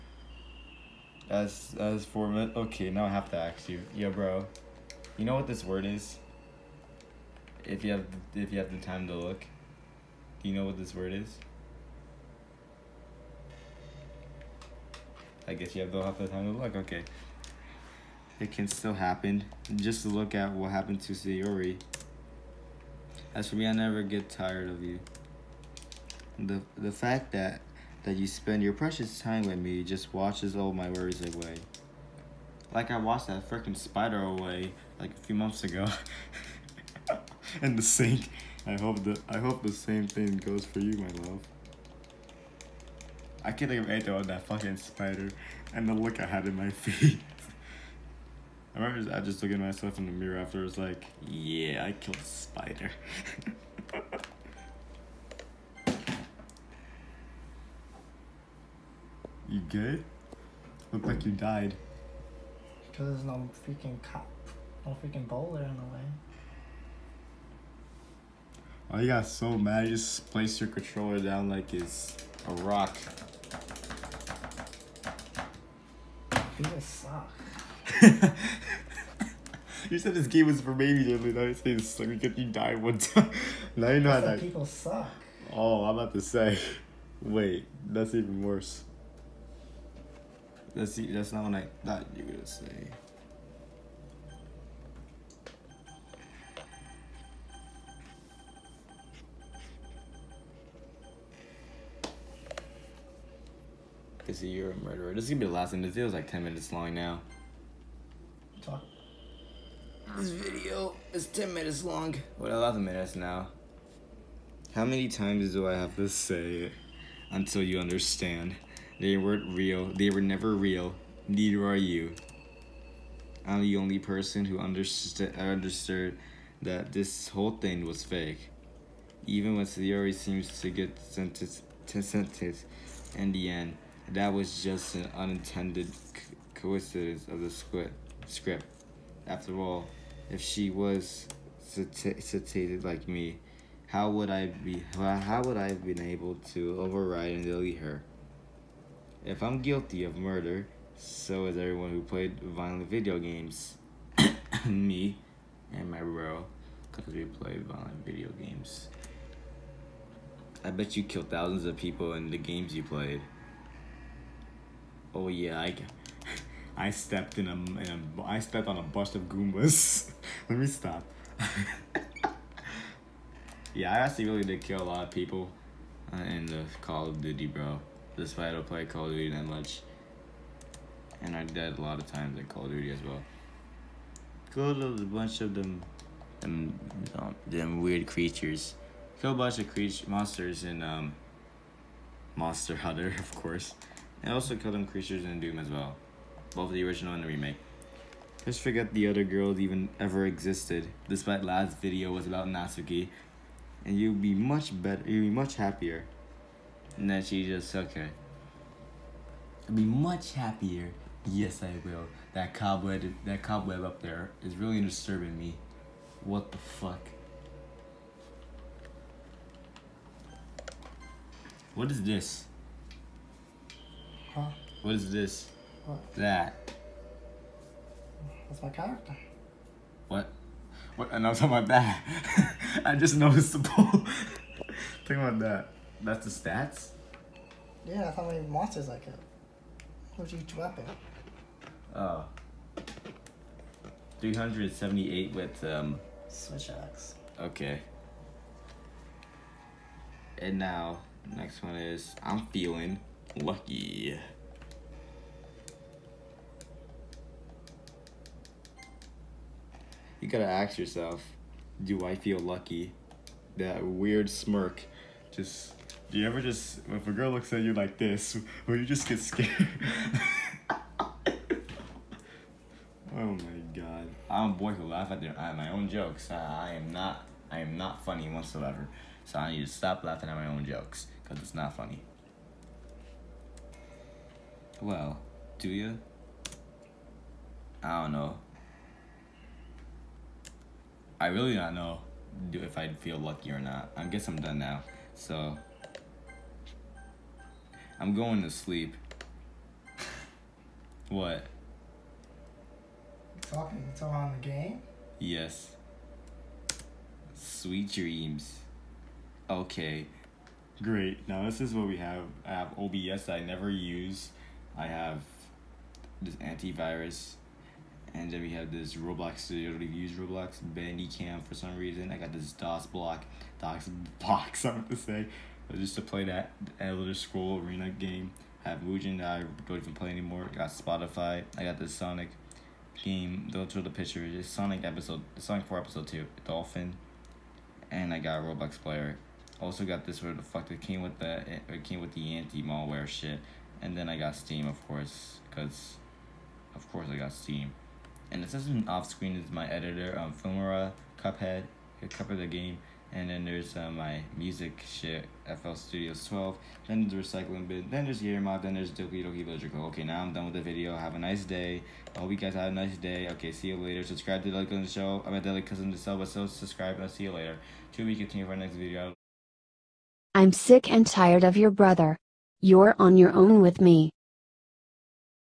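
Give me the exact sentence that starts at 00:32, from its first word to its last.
Like I washed that freaking spider away like a few months ago.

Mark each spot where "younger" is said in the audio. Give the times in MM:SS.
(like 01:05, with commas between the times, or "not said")
not said.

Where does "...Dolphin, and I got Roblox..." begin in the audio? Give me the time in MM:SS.
05:36.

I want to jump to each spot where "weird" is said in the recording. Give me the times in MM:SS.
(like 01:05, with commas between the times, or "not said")
03:07, 04:23.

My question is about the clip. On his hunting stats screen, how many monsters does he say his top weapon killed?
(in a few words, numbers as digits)
378.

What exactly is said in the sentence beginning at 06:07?
Two weeks continue for our next video.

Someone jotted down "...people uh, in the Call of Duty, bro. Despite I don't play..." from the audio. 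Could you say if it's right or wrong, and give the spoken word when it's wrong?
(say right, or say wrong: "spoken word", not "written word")
right.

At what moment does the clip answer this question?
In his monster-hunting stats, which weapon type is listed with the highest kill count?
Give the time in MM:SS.
04:06.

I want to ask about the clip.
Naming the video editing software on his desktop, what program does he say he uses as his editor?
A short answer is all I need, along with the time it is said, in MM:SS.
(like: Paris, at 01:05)
Filmora, at 05:50.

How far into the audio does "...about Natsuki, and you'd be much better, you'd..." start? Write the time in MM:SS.
03:22.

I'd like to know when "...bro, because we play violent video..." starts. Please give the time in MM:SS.
02:36.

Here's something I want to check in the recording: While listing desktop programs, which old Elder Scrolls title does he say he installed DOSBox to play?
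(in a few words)
Arena.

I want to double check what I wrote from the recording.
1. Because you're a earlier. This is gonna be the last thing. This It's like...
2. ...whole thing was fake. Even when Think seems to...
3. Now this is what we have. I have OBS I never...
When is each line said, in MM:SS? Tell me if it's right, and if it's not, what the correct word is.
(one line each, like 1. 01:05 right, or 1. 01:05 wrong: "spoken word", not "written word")
1. 01:44 wrong: "murderer", not "earlier"
2. 02:07 wrong: "Sayori", not "Think"
3. 05:11 right.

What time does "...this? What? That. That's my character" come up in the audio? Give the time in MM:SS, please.
03:45.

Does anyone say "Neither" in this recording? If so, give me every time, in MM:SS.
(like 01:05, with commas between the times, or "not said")
02:01.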